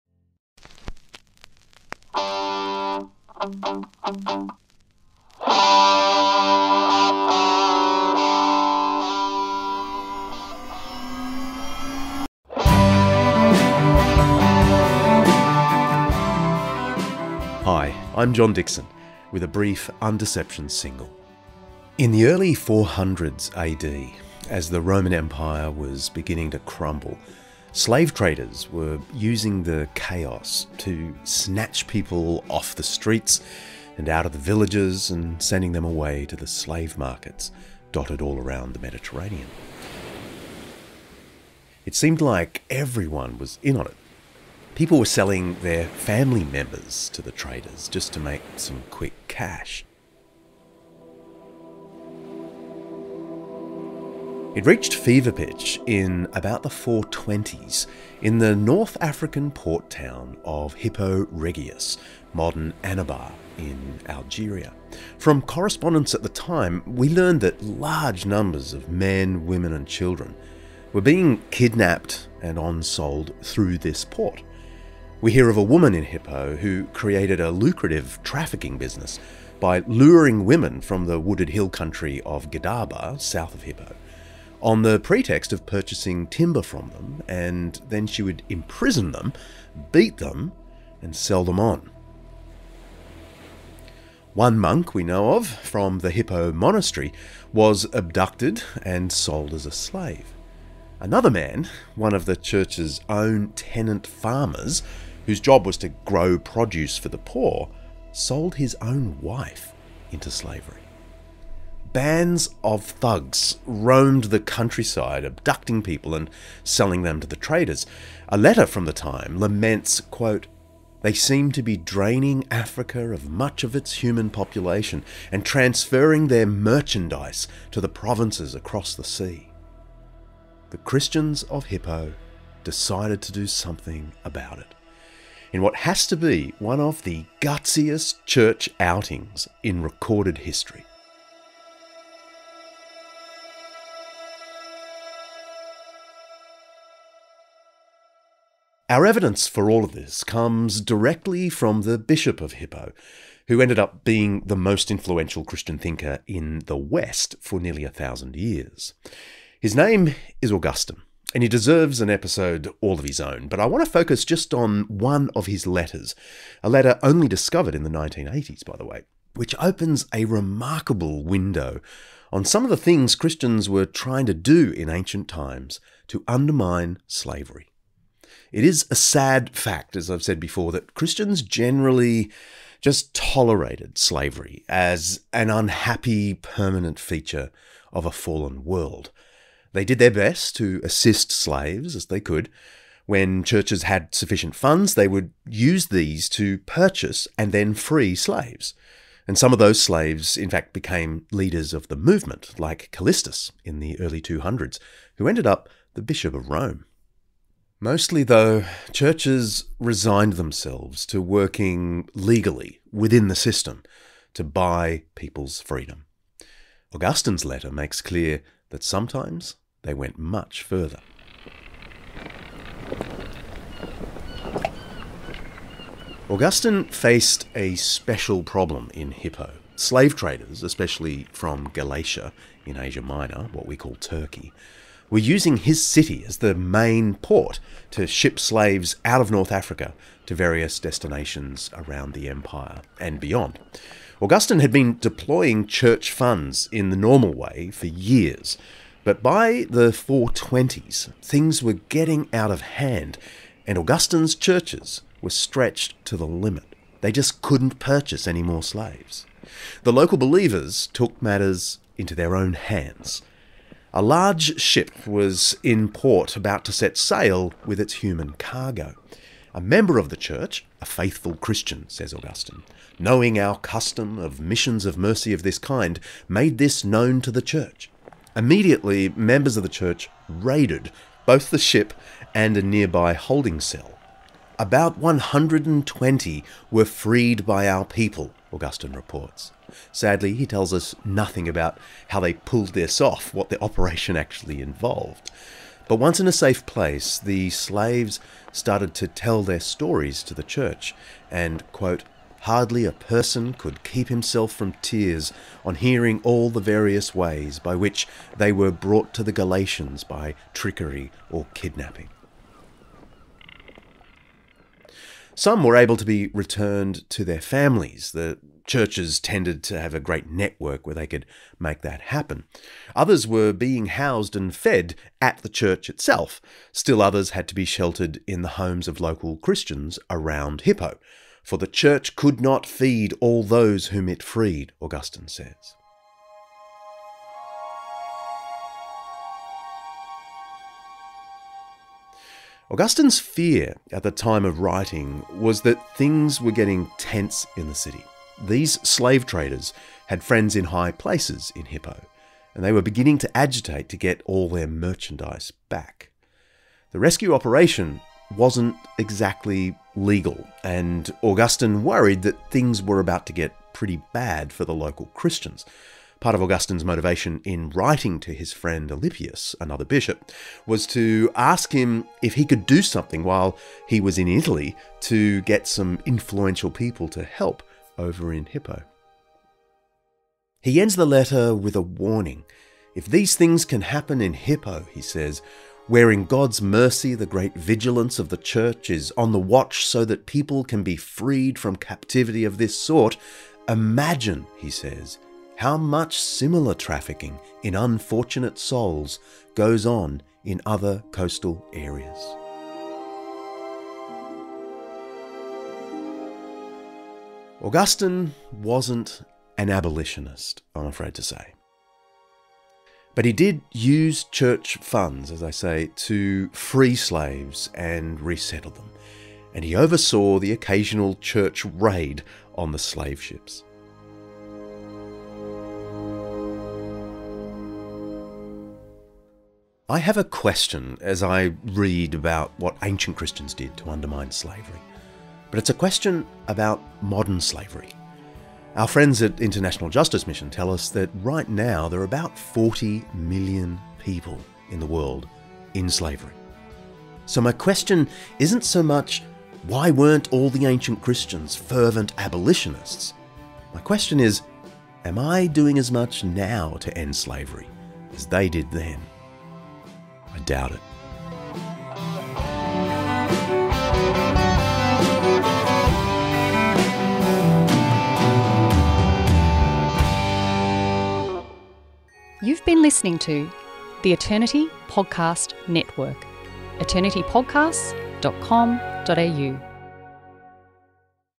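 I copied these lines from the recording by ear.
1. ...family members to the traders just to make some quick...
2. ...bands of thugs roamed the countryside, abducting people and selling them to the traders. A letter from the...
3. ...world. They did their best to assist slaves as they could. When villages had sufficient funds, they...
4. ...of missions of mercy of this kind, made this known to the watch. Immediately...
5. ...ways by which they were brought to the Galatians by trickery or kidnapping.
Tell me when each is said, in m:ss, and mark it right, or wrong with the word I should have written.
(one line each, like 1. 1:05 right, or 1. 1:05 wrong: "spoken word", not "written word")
1. 0:45 right
2. 1:51 right
3. 3:08 wrong: "churches", not "villages"
4. 4:34 wrong: "church", not "watch"
5. 5:07 right.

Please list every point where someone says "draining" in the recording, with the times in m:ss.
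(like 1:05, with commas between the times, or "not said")
2:01.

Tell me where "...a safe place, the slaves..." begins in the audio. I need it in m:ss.
4:56.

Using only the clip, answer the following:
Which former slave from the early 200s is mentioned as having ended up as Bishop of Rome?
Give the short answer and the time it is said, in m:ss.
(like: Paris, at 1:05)
Callistus, at 3:22.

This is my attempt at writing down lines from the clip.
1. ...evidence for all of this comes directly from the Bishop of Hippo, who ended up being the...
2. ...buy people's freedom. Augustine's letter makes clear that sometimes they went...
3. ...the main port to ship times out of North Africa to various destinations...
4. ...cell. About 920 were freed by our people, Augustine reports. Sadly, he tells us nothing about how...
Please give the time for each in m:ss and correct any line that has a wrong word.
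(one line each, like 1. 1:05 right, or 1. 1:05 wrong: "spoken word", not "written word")
1. 2:29 right
2. 3:34 right
3. 3:56 wrong: "slaves", not "times"
4. 4:43 wrong: "120", not "920".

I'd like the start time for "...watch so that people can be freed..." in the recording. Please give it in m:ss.
6:29.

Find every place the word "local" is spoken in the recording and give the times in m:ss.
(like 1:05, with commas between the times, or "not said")
4:19, 5:29, 6:04.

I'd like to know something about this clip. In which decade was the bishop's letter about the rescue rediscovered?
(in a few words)
1980s.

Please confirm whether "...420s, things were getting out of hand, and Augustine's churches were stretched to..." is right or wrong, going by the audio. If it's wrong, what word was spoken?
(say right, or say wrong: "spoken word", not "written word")
right.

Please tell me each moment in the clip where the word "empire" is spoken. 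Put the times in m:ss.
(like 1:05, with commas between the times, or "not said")
0:25, 4:02.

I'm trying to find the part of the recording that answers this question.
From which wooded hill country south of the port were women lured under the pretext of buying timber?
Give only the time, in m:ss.
1:22.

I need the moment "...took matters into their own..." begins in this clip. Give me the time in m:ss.
4:20.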